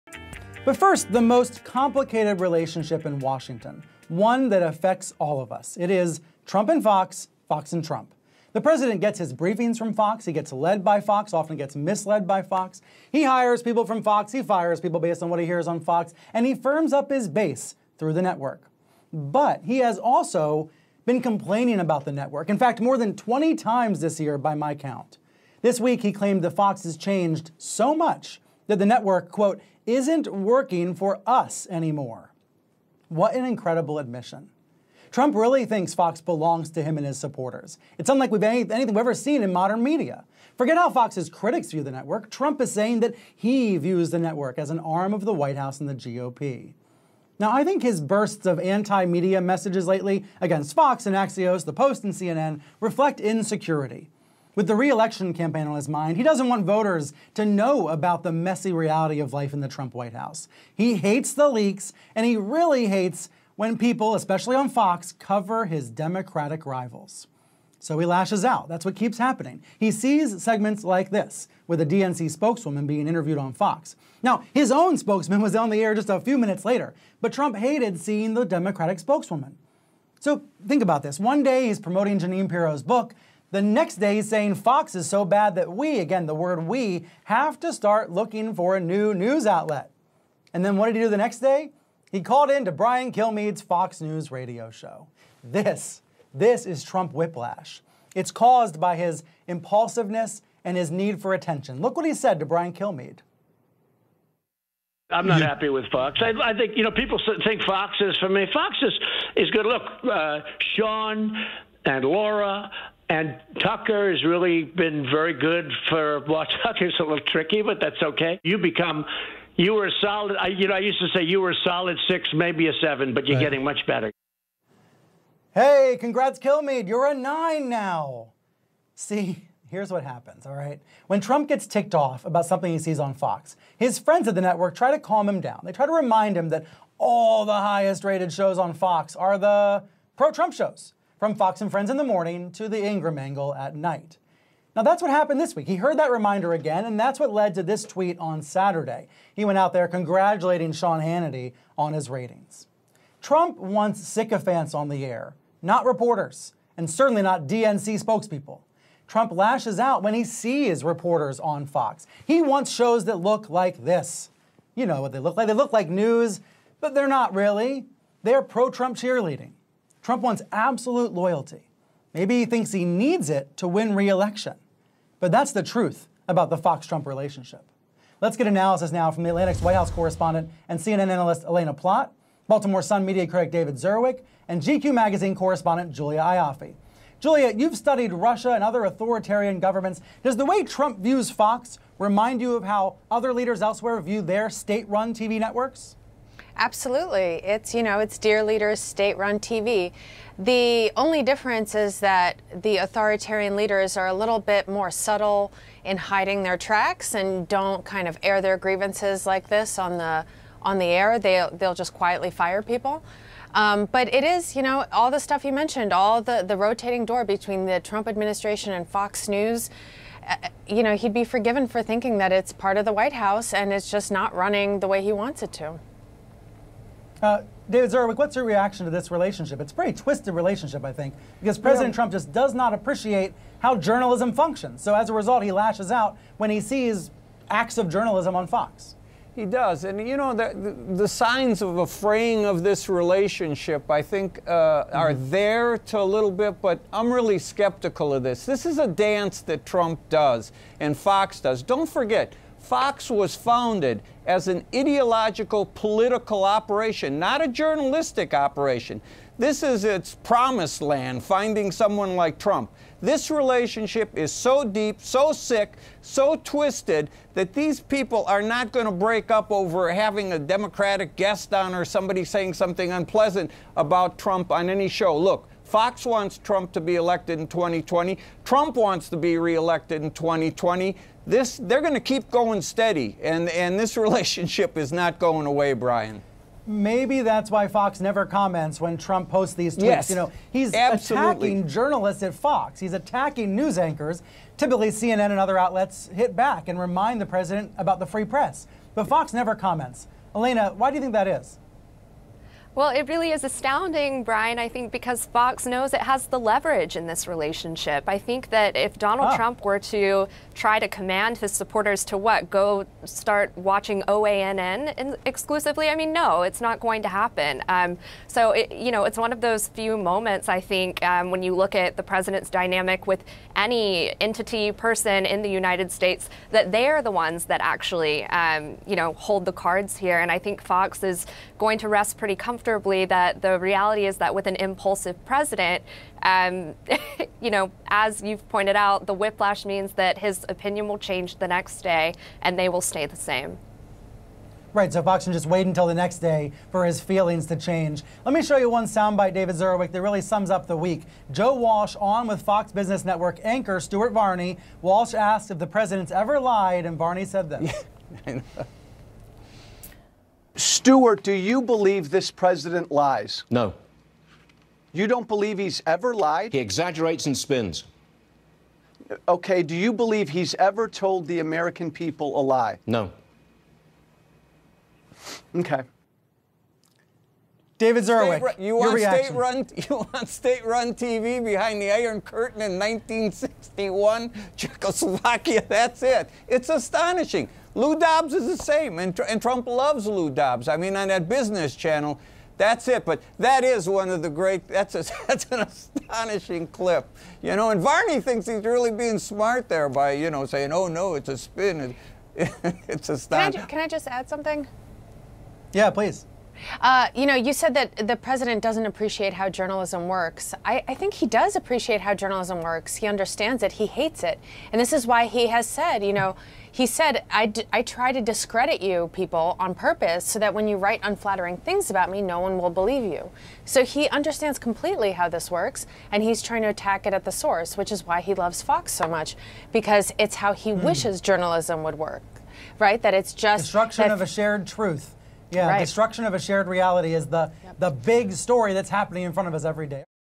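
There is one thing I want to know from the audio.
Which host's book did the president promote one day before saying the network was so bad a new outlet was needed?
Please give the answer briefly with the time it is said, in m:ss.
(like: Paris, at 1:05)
Jeanine Pirro, at 1:22.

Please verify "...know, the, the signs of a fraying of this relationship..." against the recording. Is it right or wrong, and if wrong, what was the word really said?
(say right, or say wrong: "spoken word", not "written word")
right.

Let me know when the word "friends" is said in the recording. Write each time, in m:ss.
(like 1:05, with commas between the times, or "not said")
2:13, 2:21.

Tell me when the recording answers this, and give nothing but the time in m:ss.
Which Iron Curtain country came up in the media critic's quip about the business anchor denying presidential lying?
6:24.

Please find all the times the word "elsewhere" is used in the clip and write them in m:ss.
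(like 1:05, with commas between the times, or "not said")
3:13.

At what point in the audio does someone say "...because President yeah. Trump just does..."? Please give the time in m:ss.
3:51.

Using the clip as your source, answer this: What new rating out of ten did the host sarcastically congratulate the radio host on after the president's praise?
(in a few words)
9.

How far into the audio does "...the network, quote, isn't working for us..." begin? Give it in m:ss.
0:28.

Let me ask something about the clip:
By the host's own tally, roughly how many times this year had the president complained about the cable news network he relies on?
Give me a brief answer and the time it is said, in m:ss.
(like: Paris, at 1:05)
more than 20, at 0:22.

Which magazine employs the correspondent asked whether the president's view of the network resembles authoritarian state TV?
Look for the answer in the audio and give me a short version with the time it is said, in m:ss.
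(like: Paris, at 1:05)
GQ, at 3:04.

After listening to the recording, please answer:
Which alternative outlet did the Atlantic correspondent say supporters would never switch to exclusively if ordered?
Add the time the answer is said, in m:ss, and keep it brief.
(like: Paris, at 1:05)
OANN, at 5:14.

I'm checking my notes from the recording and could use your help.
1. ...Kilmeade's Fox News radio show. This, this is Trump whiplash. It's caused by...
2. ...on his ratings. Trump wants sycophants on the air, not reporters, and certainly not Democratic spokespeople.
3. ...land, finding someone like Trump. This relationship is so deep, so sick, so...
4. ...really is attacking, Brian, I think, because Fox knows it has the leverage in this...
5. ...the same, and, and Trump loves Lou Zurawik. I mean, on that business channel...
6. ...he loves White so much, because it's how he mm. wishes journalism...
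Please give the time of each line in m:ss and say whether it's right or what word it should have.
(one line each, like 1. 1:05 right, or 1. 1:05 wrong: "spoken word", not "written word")
1. 1:33 right
2. 2:31 wrong: "DNC", not "Democratic"
3. 4:20 right
4. 5:03 wrong: "astounding", not "attacking"
5. 6:28 wrong: "Dobbs", not "Zurawik"
6. 7:08 wrong: "Fox", not "White".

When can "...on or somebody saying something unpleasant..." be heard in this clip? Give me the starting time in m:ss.
4:31.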